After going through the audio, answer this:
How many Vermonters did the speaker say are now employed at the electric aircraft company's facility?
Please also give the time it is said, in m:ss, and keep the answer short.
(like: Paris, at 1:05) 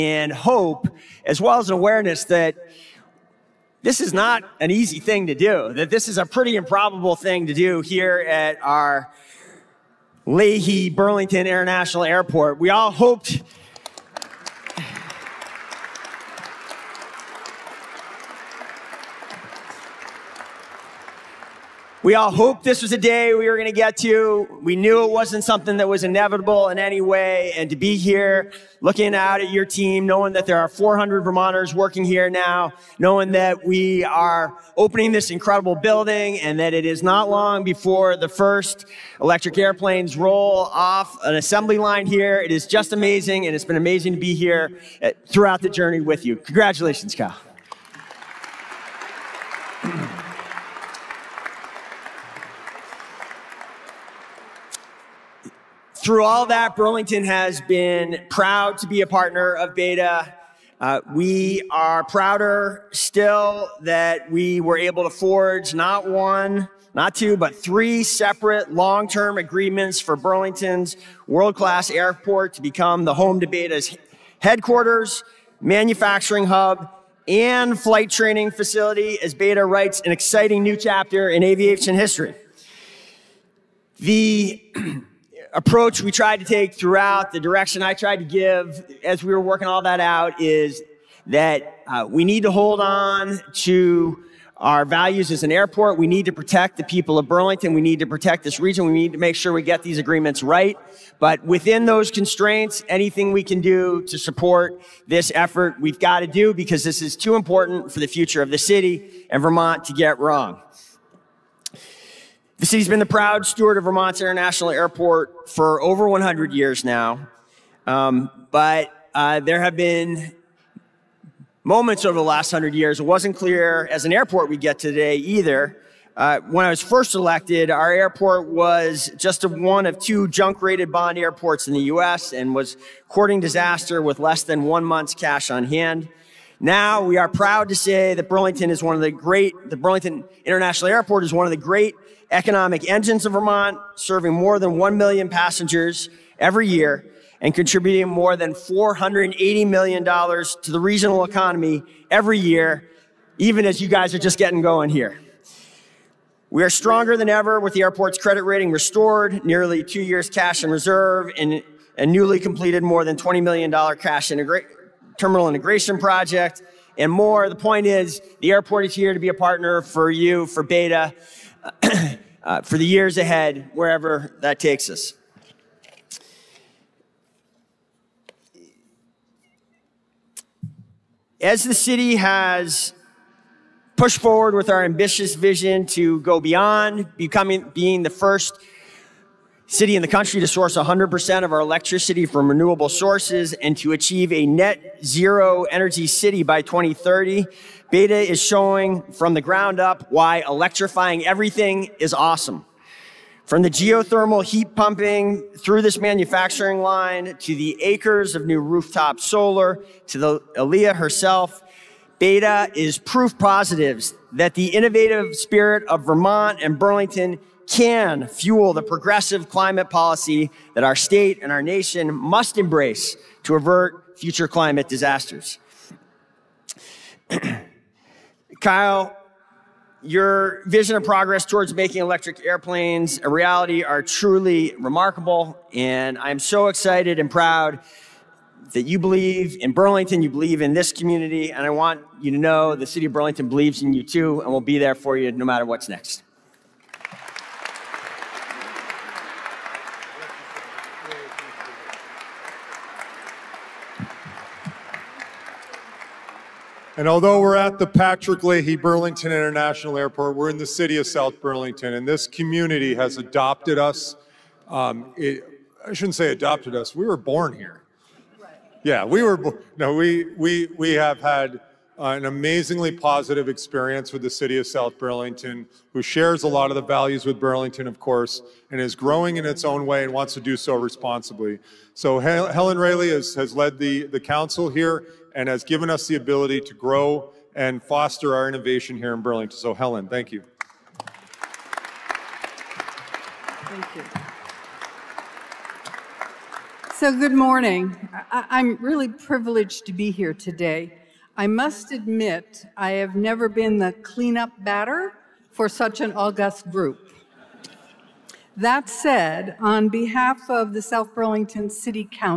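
400, at 0:30.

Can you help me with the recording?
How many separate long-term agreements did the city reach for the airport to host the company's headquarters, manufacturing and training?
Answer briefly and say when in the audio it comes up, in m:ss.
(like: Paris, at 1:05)
3, at 1:07.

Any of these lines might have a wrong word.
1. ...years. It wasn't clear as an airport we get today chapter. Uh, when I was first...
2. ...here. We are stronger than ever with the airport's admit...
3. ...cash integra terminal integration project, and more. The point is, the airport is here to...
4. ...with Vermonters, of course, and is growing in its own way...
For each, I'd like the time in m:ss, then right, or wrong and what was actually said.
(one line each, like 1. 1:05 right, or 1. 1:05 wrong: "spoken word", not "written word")
1. 2:02 wrong: "either", not "chapter"
2. 2:34 wrong: "credit", not "admit"
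3. 2:43 right
4. 4:37 wrong: "Burlington", not "Vermonters".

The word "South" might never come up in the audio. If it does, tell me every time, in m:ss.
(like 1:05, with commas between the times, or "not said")
4:21, 4:34, 5:10.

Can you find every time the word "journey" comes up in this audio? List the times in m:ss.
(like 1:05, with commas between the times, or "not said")
0:45.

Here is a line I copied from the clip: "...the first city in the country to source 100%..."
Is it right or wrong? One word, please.
right.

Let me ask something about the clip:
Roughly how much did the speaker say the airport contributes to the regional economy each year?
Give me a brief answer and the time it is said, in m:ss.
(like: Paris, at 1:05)
$480 million, at 2:28.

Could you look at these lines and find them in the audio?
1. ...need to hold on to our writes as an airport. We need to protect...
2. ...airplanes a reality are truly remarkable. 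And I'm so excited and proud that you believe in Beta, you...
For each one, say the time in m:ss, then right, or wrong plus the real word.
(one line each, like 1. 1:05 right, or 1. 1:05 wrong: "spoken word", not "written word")
1. 1:32 wrong: "values", not "writes"
2. 3:52 wrong: "Burlington", not "Beta".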